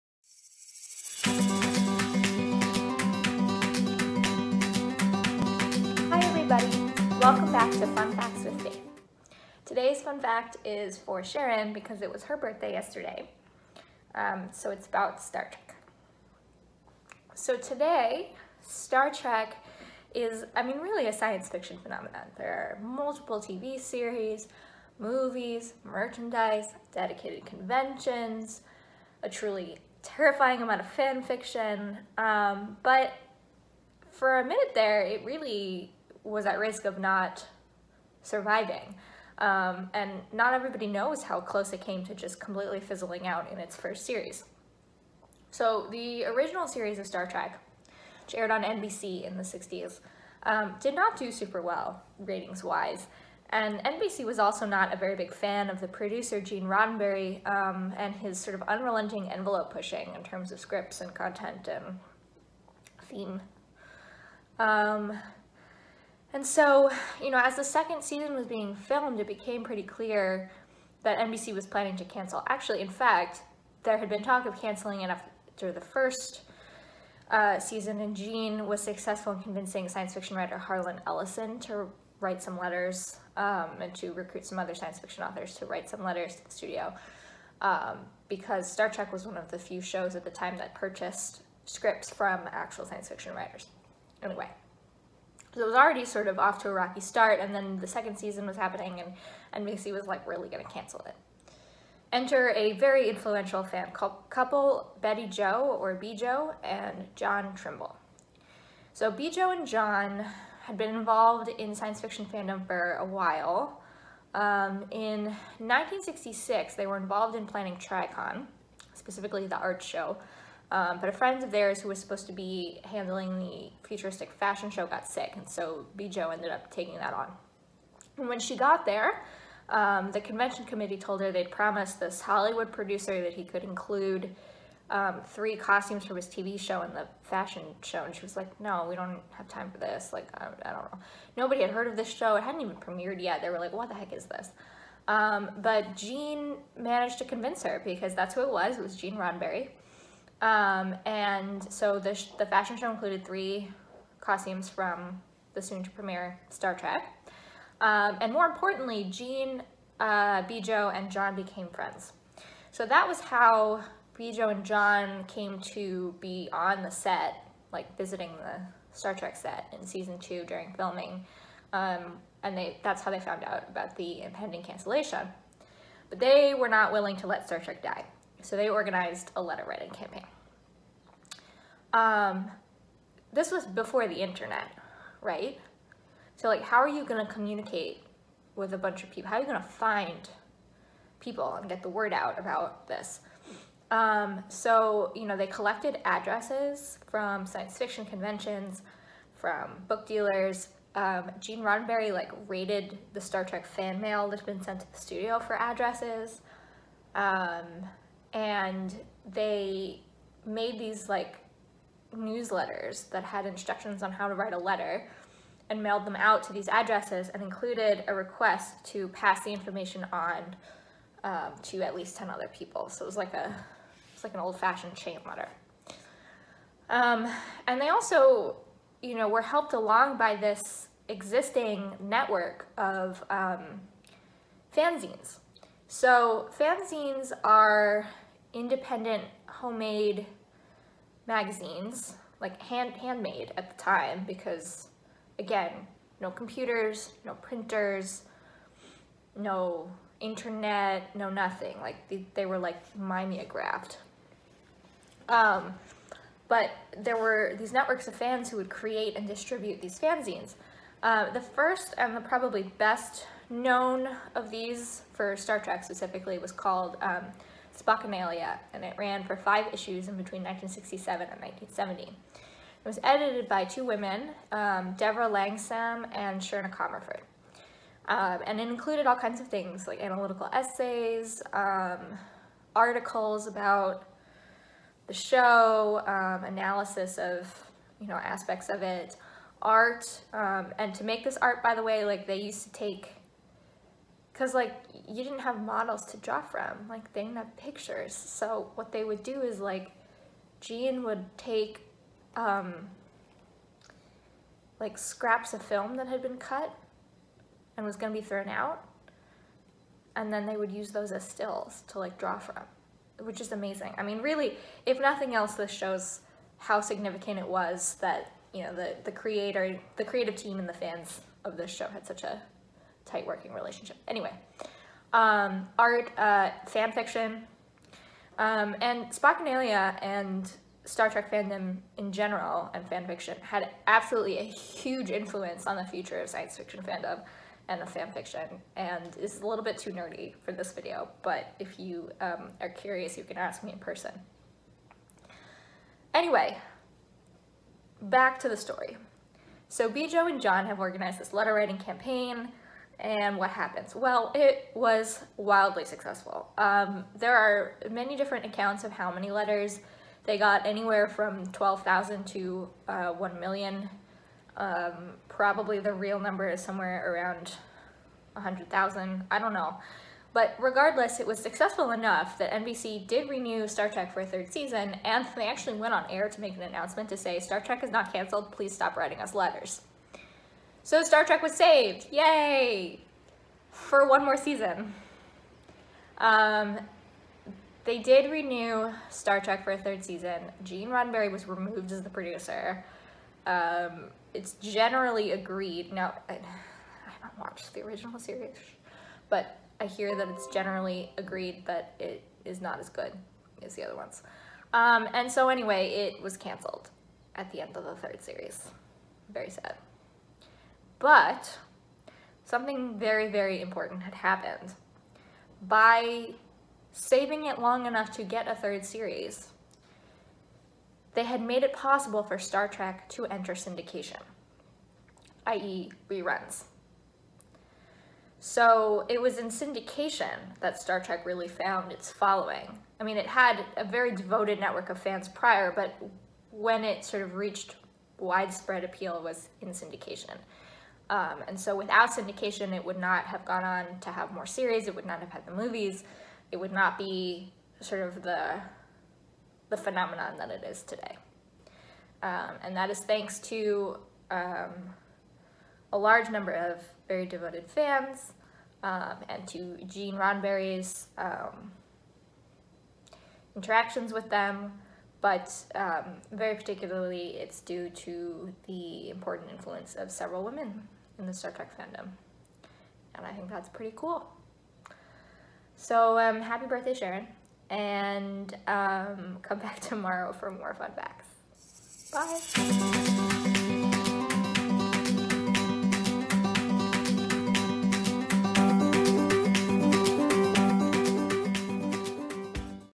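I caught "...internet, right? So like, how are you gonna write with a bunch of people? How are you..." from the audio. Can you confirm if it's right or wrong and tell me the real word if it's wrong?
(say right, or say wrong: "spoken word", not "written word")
wrong: "communicate", not "write".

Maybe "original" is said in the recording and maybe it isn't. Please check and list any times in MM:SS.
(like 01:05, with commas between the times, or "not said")
00:46, 06:37.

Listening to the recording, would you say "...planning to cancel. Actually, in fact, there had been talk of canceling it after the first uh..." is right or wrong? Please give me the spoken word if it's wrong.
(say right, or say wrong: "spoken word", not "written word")
right.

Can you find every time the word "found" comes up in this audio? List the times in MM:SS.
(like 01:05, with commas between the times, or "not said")
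02:53, 07:11.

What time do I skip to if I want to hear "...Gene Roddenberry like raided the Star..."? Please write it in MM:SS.
03:21.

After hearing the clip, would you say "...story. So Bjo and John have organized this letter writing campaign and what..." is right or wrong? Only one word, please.
right.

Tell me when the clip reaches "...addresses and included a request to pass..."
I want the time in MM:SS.
03:36.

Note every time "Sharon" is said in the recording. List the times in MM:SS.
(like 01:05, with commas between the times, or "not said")
00:11, 07:56.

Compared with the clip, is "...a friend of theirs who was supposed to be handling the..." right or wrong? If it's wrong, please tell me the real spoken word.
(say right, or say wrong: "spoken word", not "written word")
right.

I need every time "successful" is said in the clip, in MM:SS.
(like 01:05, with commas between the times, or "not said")
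01:18, 05:55, 06:11.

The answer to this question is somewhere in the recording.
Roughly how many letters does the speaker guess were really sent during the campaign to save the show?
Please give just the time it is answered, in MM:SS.
06:08.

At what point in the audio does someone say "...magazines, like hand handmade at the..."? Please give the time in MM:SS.
04:01.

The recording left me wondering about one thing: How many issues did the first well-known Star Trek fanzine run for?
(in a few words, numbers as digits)
5.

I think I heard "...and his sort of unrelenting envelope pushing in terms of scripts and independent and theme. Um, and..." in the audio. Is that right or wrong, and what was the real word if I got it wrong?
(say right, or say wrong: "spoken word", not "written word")
wrong: "content", not "independent".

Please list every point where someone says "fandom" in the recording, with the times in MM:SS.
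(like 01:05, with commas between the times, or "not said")
01:52, 05:31, 05:36, 07:51.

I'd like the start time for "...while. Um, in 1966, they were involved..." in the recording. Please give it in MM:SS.
01:53.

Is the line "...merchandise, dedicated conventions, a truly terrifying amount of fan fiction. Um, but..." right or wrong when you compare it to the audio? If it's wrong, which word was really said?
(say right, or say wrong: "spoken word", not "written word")
right.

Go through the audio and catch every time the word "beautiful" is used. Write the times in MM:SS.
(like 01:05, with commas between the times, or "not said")
not said.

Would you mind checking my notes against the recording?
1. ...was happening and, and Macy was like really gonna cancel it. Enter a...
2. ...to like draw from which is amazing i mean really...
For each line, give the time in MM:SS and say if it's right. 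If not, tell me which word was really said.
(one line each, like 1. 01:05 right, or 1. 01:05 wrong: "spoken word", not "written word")
1. 01:38 right
2. 05:11 right.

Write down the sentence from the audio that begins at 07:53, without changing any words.
And I think that's pretty cool.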